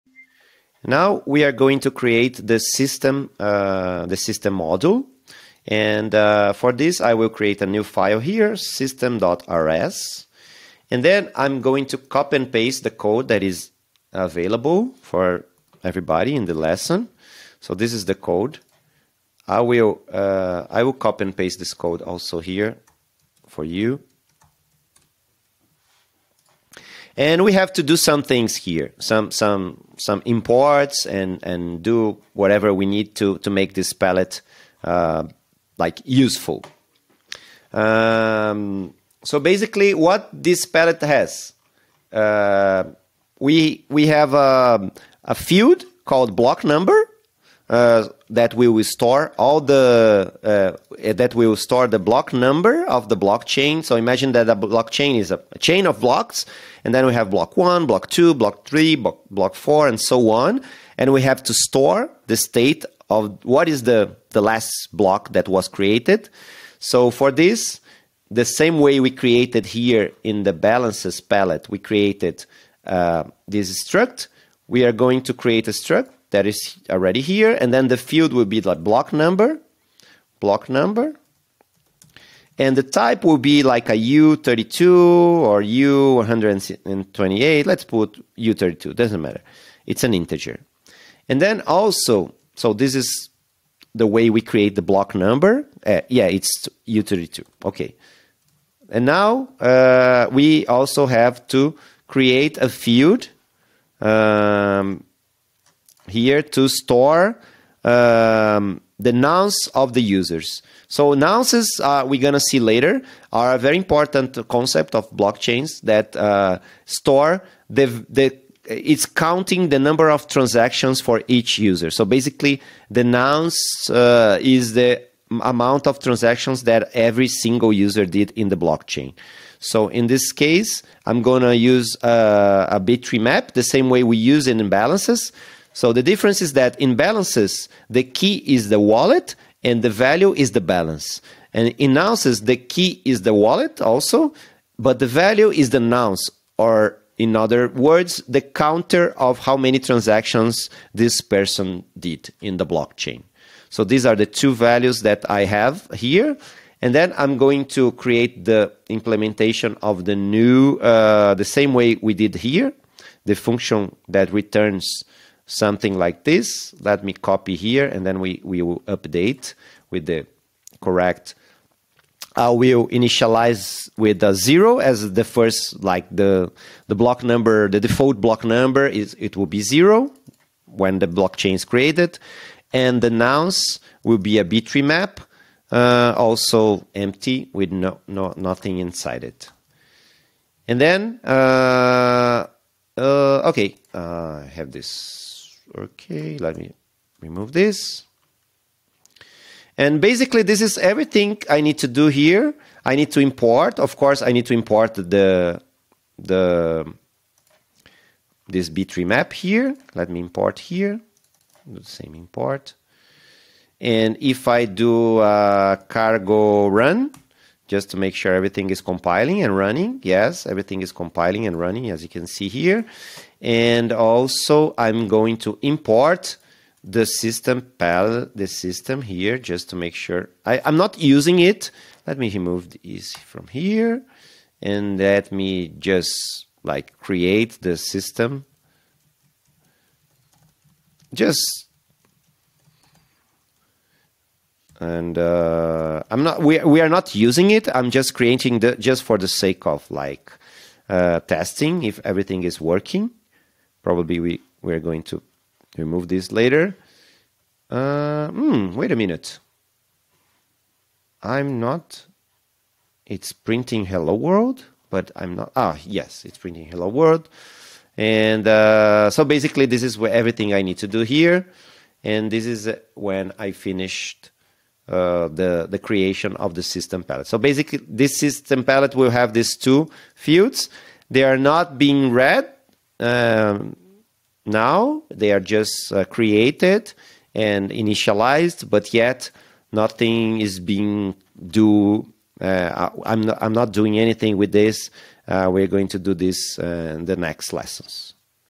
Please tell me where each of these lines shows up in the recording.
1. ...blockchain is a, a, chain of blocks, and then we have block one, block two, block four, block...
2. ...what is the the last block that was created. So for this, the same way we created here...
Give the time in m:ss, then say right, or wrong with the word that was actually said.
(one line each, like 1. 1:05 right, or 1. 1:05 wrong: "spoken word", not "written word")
1. 0:54 wrong: "three", not "four"
2. 1:03 right.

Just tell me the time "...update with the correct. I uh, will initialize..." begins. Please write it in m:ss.
2:48.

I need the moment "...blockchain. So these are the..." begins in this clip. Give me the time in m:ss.
2:32.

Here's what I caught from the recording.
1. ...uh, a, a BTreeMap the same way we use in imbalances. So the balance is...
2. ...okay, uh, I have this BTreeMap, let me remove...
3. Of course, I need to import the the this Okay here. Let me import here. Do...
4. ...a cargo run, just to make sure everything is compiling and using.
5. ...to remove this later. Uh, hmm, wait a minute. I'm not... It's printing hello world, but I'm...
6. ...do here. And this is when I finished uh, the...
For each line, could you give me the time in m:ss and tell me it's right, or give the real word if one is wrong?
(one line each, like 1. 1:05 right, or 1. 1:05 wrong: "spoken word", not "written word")
1. 2:12 wrong: "difference", not "balance"
2. 3:13 wrong: "Okay", not "BTreeMap"
3. 3:23 wrong: "BTreeMap", not "Okay"
4. 3:35 wrong: "running", not "using"
5. 4:15 right
6. 4:30 right.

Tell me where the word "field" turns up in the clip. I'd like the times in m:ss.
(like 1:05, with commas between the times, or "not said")
0:45, 1:17, 1:42, 4:40.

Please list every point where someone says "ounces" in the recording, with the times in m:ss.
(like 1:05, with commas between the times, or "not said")
2:21.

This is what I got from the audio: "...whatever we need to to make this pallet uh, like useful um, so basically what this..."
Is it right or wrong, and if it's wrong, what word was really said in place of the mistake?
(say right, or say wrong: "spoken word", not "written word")
right.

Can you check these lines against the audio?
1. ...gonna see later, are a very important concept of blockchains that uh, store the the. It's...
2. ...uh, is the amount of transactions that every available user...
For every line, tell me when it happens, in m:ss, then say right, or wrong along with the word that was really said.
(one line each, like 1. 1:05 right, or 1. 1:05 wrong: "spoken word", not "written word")
1. 1:52 right
2. 2:03 wrong: "single", not "available".